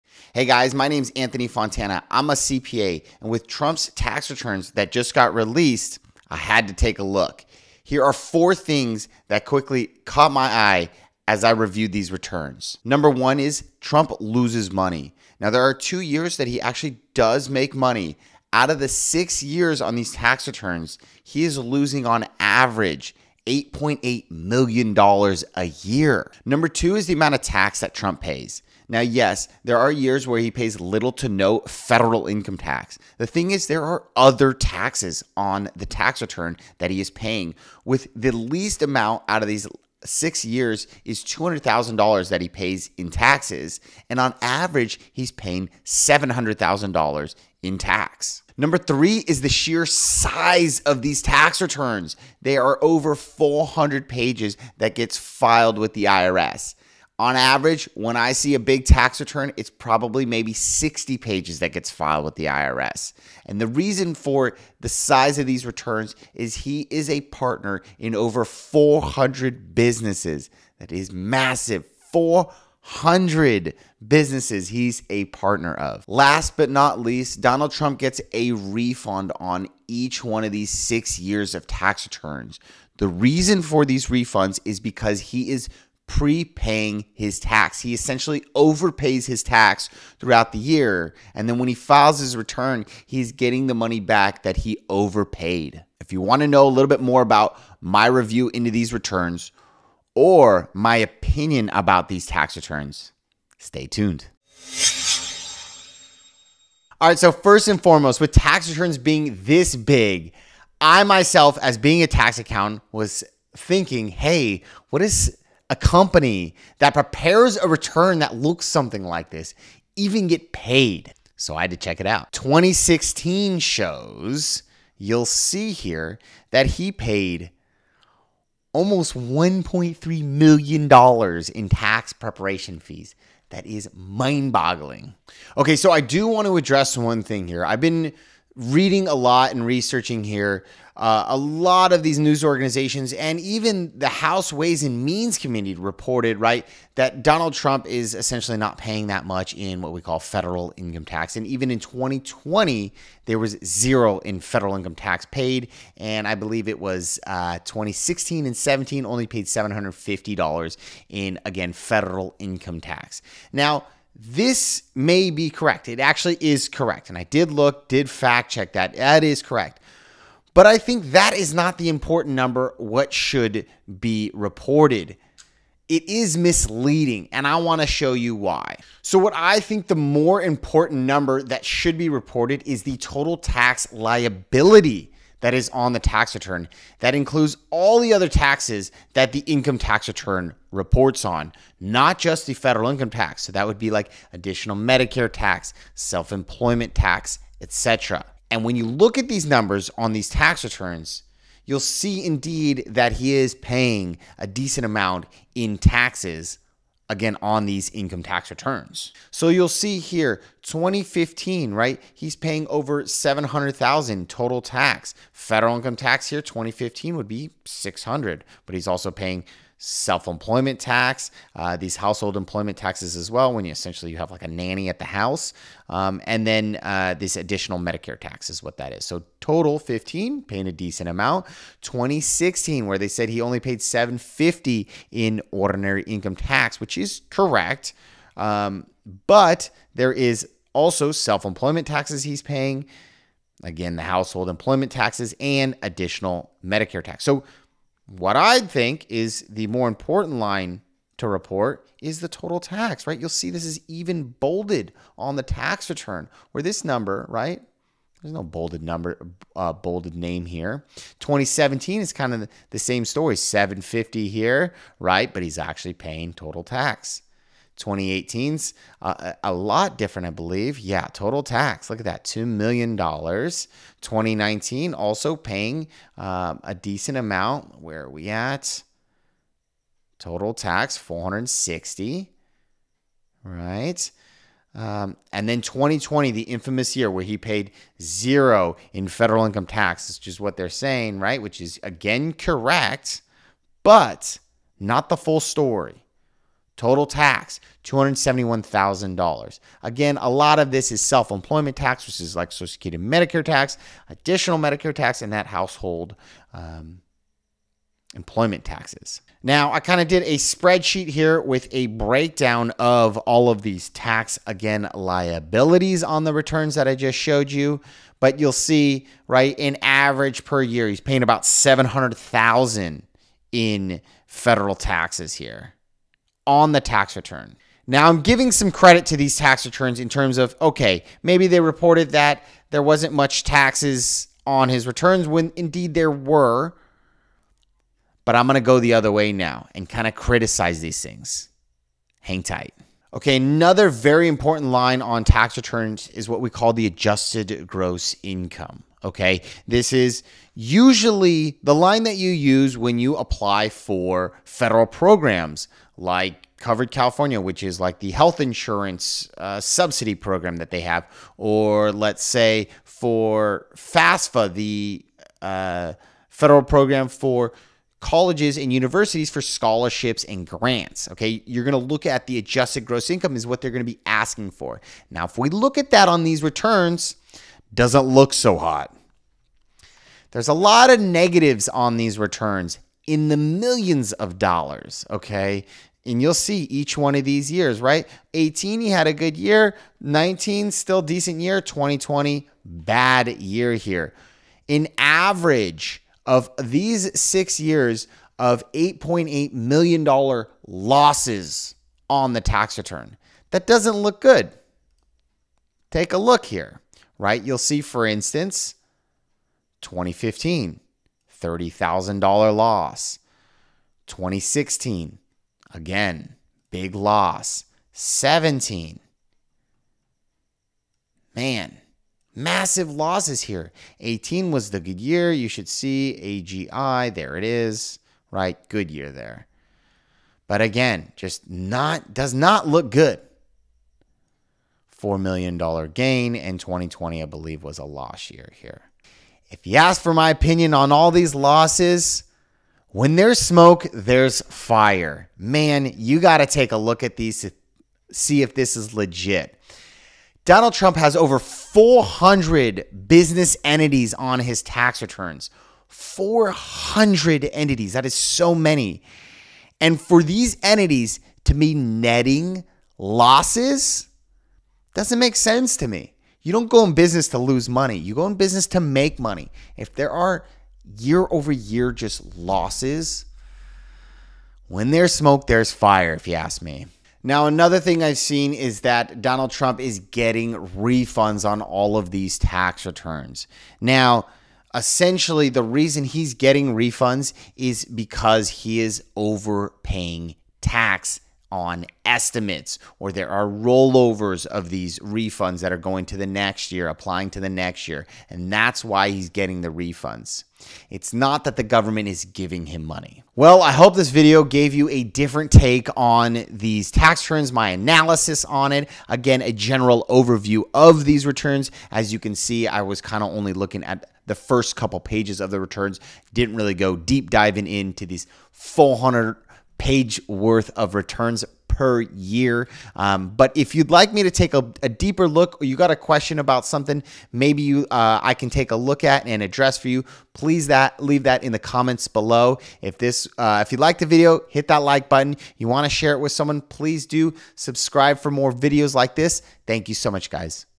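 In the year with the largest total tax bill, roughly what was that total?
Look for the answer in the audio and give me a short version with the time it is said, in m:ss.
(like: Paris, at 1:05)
$2 million, at 4:32.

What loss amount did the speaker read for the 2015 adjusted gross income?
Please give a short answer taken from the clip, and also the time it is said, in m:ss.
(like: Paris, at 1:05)
$30,000, at 6:51.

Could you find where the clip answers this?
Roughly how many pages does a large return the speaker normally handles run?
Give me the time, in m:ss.
1:00.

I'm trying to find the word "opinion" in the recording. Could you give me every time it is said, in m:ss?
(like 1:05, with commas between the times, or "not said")
1:40, 7:20.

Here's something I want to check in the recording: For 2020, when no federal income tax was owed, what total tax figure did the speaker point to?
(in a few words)
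$271,000.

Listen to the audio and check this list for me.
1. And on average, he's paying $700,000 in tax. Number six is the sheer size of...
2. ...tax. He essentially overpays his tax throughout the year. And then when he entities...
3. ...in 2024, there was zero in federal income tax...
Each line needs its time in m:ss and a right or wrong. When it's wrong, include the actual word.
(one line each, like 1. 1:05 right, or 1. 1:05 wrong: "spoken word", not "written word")
1. 0:44 wrong: "three", not "six"
2. 1:27 wrong: "files", not "entities"
3. 2:31 wrong: "2020", not "2024".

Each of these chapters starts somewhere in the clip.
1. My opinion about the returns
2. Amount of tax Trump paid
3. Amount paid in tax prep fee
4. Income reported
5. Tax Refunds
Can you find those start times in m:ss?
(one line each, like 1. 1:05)
1. 7:18
2. 2:14
3. 1:49
4. 5:42
5. 7:56.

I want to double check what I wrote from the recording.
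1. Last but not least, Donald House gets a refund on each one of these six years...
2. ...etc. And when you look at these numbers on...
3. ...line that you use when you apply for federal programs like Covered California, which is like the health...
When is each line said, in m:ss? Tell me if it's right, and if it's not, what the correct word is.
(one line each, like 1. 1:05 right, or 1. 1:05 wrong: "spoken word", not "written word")
1. 1:16 wrong: "Trump", not "House"
2. 3:17 right
3. 5:51 right.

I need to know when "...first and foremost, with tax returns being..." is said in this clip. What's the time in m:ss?
1:47.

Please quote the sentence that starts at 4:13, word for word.
You'll see this is even bolded on the tax return, where this number, right?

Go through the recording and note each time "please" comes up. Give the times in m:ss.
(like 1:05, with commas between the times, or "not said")
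8:50, 8:56.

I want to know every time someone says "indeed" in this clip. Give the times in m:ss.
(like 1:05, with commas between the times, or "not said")
3:22, 5:35.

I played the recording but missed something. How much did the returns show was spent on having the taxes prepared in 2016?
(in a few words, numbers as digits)
$1.3 million.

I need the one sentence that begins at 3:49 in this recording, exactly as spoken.
So total 15, paying a decent amount.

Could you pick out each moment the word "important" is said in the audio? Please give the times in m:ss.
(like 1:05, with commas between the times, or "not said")
2:51, 3:00, 4:09, 5:44.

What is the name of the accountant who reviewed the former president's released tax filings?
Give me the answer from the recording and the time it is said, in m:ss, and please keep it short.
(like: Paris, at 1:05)
Anthony Fontana, at 0:01.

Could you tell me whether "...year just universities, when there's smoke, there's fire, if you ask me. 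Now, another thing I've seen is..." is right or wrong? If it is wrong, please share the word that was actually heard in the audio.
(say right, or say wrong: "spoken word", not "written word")
wrong: "losses", not "universities".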